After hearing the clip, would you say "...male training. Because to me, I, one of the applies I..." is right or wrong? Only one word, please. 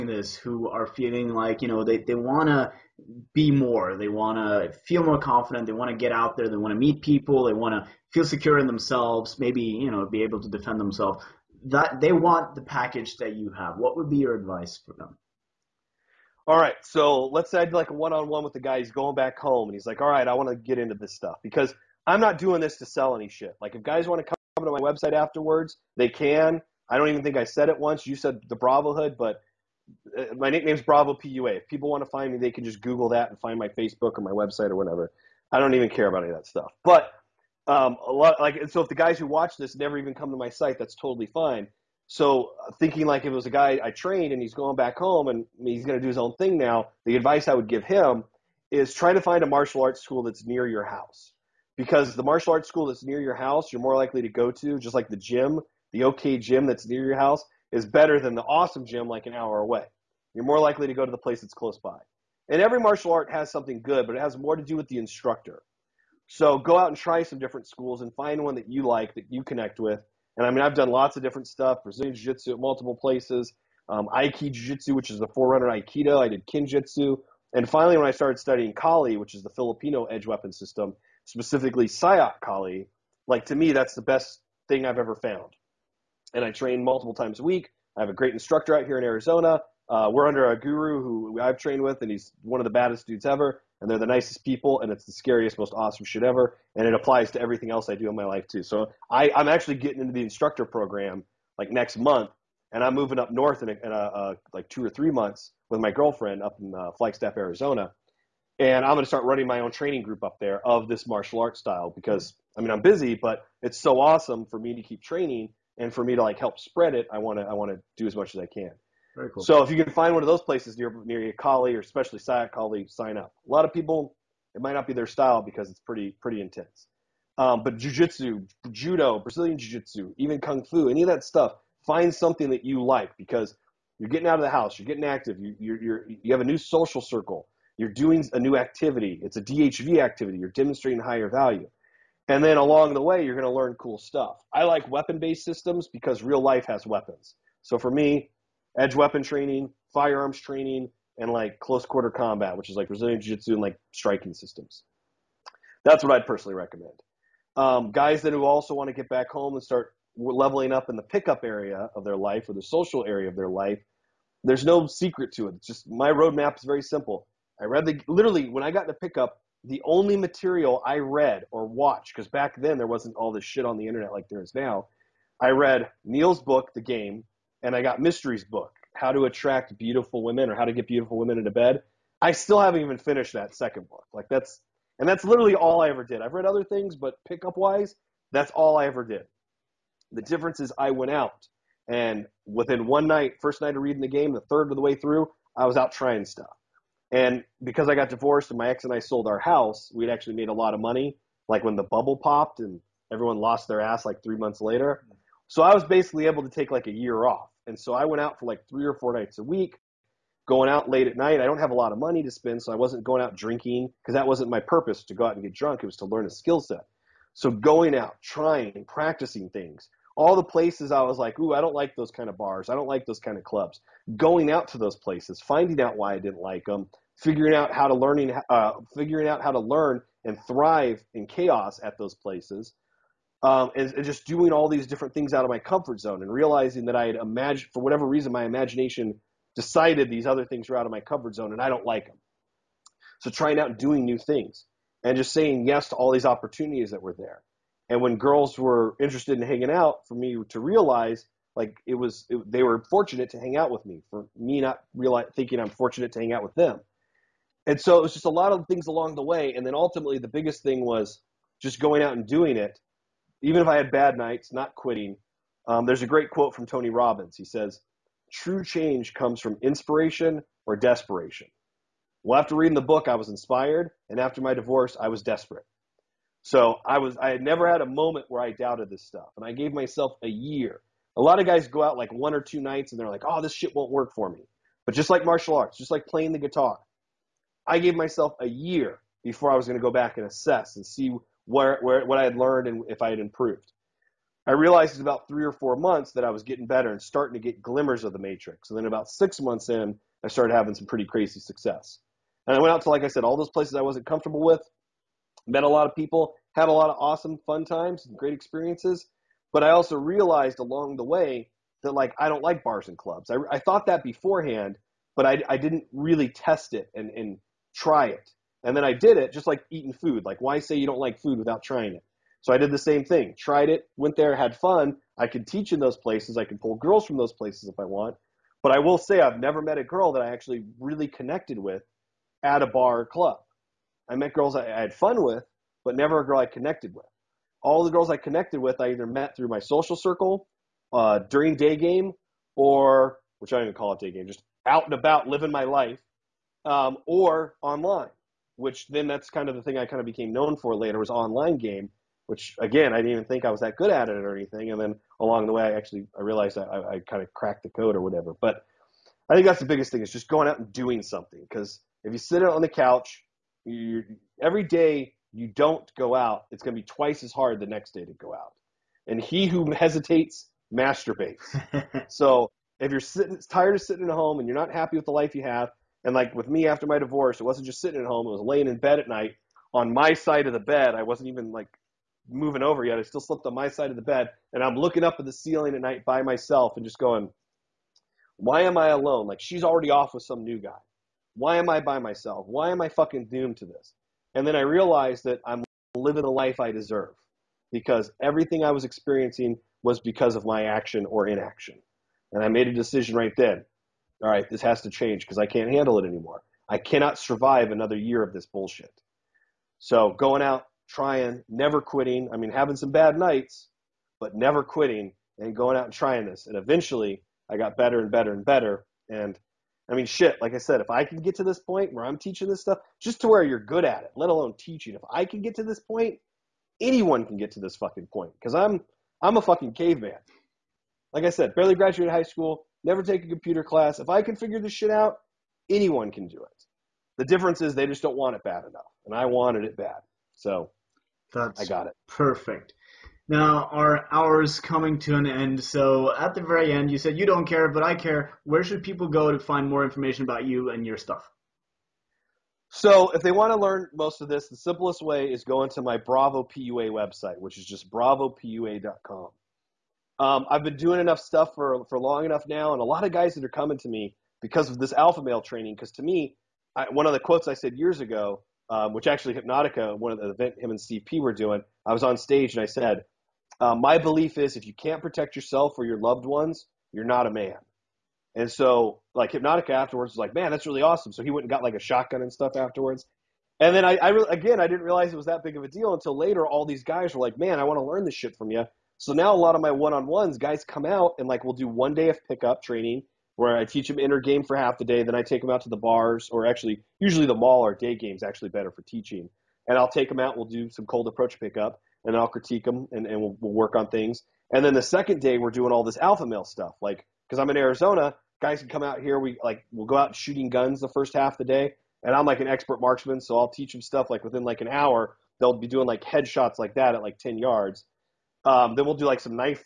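wrong.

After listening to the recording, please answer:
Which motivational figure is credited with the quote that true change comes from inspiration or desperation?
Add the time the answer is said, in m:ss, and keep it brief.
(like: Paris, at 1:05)
Tony Robbins, at 4:26.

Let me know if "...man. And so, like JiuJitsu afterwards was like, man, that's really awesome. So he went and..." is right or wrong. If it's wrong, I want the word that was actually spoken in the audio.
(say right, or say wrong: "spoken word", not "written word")
wrong: "Hypnotica", not "JiuJitsu".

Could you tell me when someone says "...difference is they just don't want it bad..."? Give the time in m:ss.
7:17.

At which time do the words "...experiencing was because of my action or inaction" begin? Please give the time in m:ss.
6:38.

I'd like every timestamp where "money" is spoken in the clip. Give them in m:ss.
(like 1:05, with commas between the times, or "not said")
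3:20, 3:31.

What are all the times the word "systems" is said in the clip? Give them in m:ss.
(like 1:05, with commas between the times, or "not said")
1:20, 2:25, 2:34.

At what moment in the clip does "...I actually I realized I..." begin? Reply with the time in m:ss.
5:55.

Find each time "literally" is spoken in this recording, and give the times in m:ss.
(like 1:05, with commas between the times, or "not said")
2:48, 3:05.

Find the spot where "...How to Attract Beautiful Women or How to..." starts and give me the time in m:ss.
2:58.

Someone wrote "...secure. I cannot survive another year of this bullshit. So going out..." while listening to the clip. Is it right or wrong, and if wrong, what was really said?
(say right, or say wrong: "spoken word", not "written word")
wrong: "anymore", not "secure".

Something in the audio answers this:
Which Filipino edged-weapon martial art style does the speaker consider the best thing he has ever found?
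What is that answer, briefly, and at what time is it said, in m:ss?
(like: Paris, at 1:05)
Sayoc Kali, at 1:21.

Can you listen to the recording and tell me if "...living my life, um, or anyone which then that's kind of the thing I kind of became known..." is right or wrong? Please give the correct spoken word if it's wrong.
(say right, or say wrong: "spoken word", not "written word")
wrong: "online", not "anyone".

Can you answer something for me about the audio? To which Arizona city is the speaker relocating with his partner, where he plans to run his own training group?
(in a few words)
Flagstaff.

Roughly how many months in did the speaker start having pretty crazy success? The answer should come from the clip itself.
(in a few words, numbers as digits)
6.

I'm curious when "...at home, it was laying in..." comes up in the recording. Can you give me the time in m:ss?
6:18.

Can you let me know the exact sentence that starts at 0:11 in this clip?
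That they want the package that you have.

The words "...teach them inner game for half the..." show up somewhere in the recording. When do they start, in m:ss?
8:13.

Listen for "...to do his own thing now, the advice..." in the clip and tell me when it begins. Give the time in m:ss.
0:45.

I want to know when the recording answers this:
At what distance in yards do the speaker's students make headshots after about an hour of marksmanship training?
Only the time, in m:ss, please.
8:37.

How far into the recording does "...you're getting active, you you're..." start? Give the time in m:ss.
2:14.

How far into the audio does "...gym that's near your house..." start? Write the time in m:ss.
0:56.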